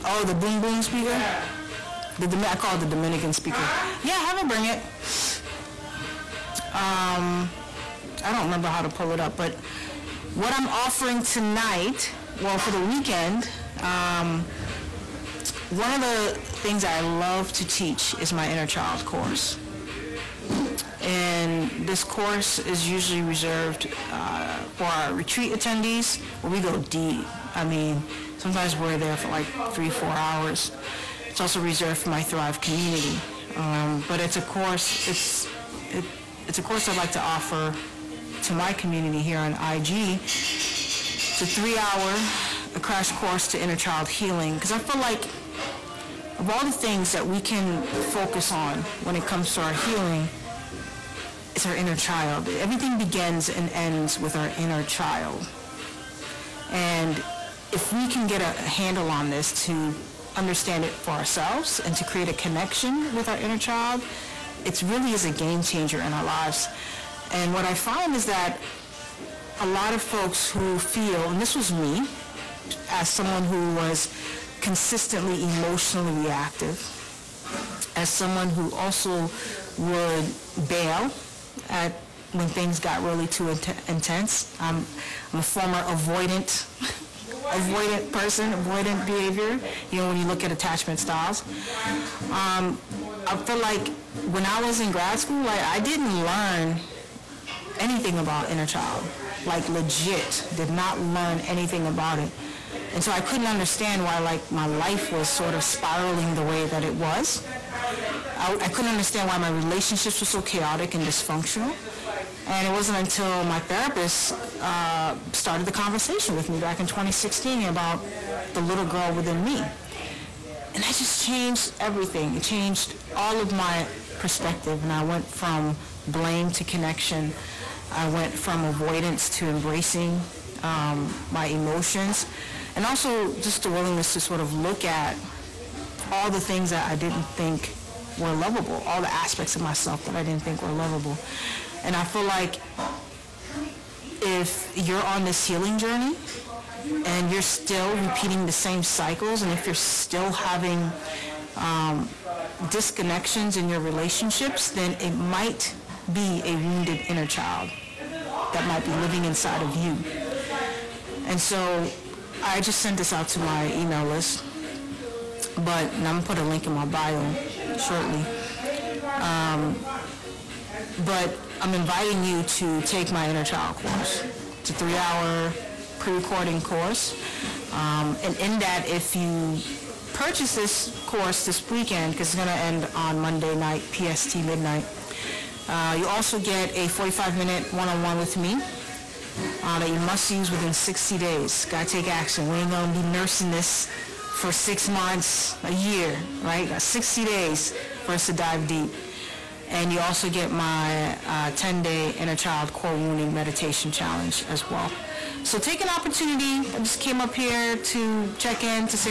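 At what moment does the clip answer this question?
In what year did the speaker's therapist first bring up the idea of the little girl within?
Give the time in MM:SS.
01:56.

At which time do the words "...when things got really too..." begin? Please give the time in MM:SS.
01:22.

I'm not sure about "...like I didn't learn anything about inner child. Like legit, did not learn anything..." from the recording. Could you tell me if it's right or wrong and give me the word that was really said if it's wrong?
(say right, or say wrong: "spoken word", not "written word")
right.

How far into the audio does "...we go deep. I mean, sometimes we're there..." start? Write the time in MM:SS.
00:26.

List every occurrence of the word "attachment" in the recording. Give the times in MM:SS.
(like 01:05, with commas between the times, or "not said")
01:30.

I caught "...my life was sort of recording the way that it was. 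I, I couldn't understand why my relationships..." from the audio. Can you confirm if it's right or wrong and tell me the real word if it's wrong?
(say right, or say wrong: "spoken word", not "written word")
wrong: "spiraling", not "recording".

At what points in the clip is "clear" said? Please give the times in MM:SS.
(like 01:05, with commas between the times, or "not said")
not said.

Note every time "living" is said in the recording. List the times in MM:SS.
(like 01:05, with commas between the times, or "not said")
02:38.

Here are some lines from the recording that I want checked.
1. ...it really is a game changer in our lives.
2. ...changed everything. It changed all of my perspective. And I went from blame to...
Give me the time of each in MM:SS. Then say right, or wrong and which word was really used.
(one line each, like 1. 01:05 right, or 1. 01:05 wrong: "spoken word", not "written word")
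1. 01:04 right
2. 02:01 right.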